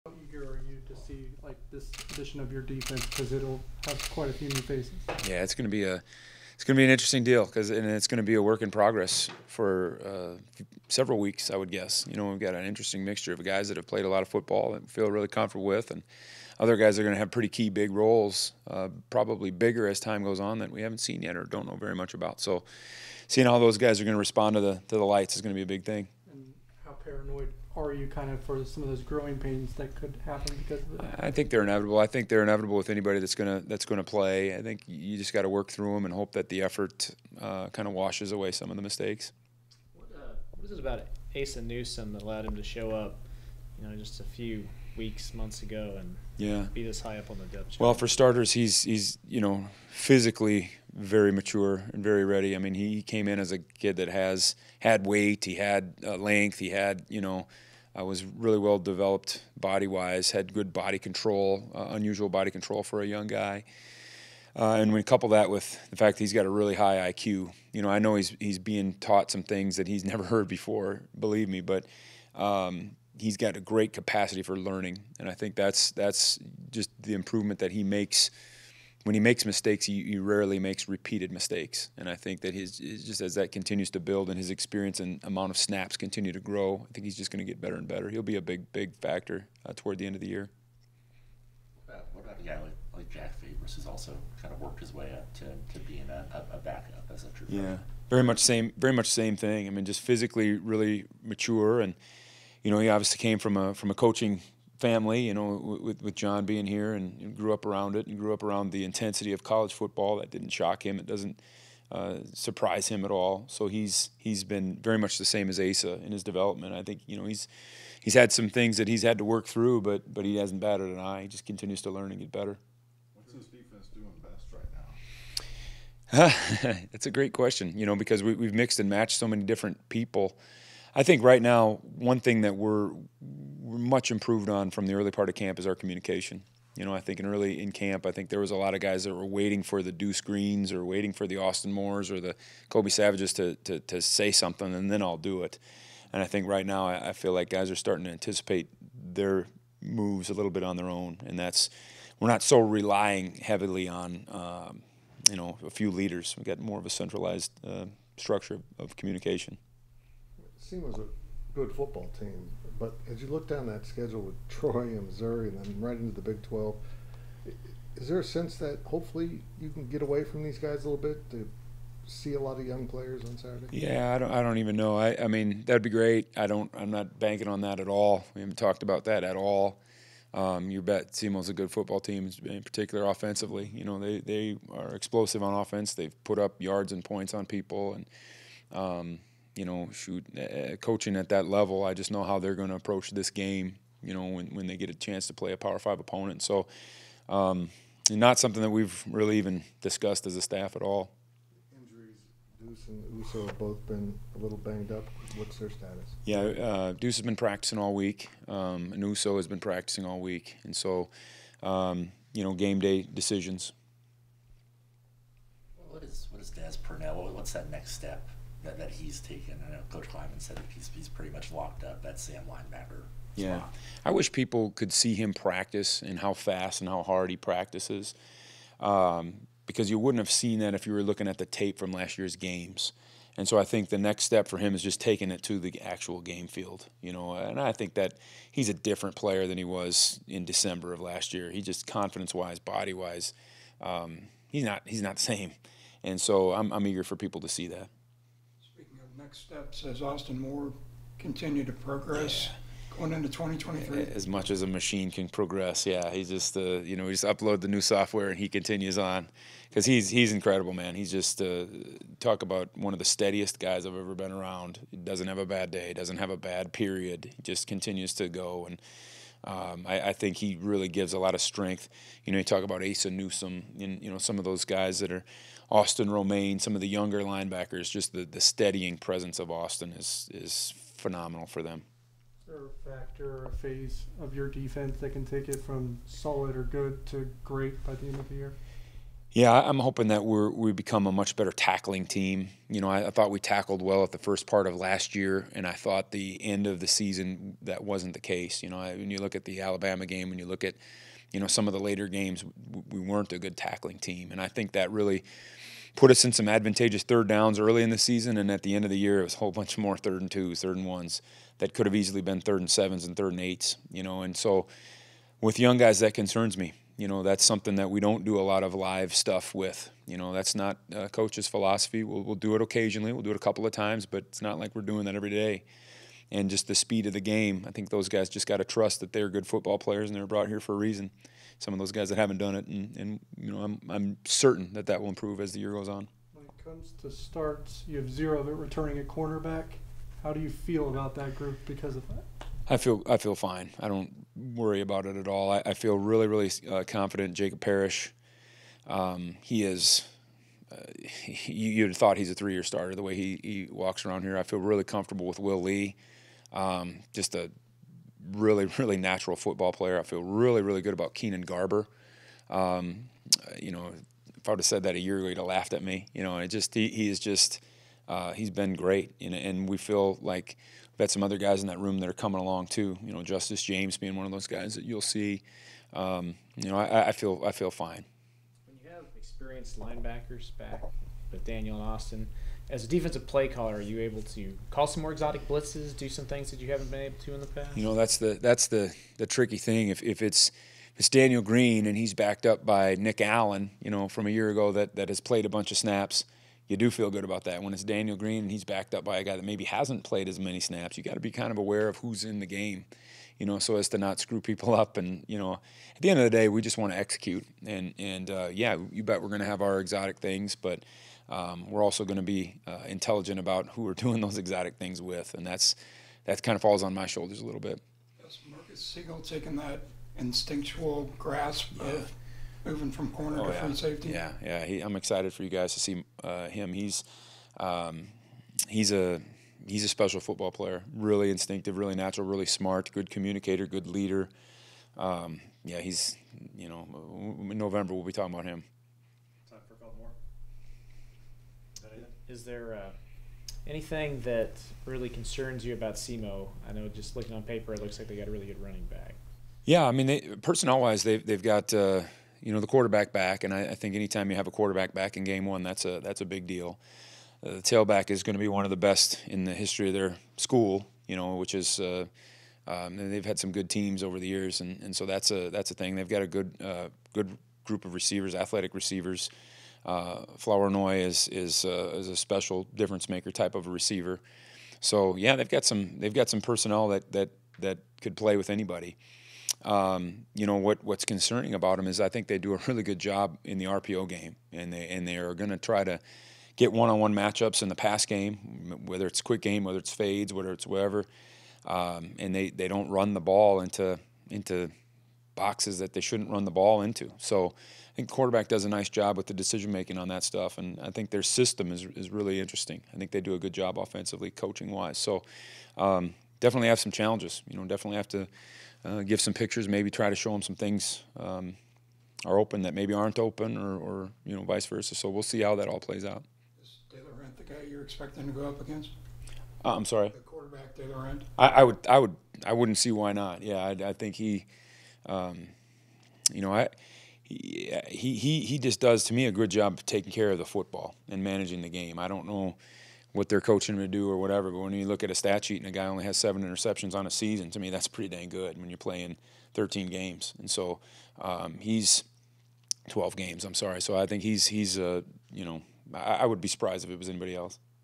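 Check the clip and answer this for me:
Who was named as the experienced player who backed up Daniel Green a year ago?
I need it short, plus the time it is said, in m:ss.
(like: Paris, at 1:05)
Nick Allen, at 6:32.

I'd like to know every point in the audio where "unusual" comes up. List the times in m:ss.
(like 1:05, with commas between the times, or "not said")
1:01.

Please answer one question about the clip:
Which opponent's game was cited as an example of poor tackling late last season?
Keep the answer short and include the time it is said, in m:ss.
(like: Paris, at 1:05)
Alabama, at 4:59.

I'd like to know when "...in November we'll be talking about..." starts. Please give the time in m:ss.
7:17.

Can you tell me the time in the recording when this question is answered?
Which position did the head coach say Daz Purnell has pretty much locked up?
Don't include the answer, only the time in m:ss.
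3:42.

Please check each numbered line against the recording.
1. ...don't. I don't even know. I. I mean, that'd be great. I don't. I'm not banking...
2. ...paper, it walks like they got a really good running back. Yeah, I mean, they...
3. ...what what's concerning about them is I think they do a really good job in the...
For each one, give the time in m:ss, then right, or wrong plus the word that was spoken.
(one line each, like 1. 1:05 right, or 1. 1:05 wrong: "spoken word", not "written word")
1. 2:54 right
2. 7:27 wrong: "looks", not "walks"
3. 8:00 right.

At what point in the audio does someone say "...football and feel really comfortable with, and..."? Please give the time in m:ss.
0:14.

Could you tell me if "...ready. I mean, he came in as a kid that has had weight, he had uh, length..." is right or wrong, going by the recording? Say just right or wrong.
right.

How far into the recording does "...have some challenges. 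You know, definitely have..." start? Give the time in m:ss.
8:26.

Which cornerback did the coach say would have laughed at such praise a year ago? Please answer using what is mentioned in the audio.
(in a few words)
Keenan Garber.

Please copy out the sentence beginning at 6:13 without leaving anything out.
You know, Justice James being one of those guys that you'll see.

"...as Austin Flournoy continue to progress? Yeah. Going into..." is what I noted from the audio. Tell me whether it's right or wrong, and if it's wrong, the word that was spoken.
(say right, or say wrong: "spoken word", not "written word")
wrong: "Moore", not "Flournoy".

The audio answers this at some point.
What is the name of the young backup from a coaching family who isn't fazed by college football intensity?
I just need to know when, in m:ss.
1:33.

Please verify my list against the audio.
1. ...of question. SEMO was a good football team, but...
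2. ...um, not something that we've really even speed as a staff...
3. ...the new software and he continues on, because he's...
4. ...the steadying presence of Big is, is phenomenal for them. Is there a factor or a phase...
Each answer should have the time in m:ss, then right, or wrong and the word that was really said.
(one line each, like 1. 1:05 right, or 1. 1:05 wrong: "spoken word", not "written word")
1. 2:38 wrong: "communication", not "question"
2. 3:17 wrong: "discussed", not "speed"
3. 4:17 right
4. 4:38 wrong: "Austin", not "Big".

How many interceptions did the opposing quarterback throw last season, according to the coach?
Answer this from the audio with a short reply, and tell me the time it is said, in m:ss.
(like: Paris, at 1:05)
7, at 8:56.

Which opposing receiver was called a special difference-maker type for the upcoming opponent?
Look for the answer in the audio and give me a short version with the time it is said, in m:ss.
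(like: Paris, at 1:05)
Flournoy, at 7:50.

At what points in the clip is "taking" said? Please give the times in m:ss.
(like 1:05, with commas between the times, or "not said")
3:54, 6:59, 8:49.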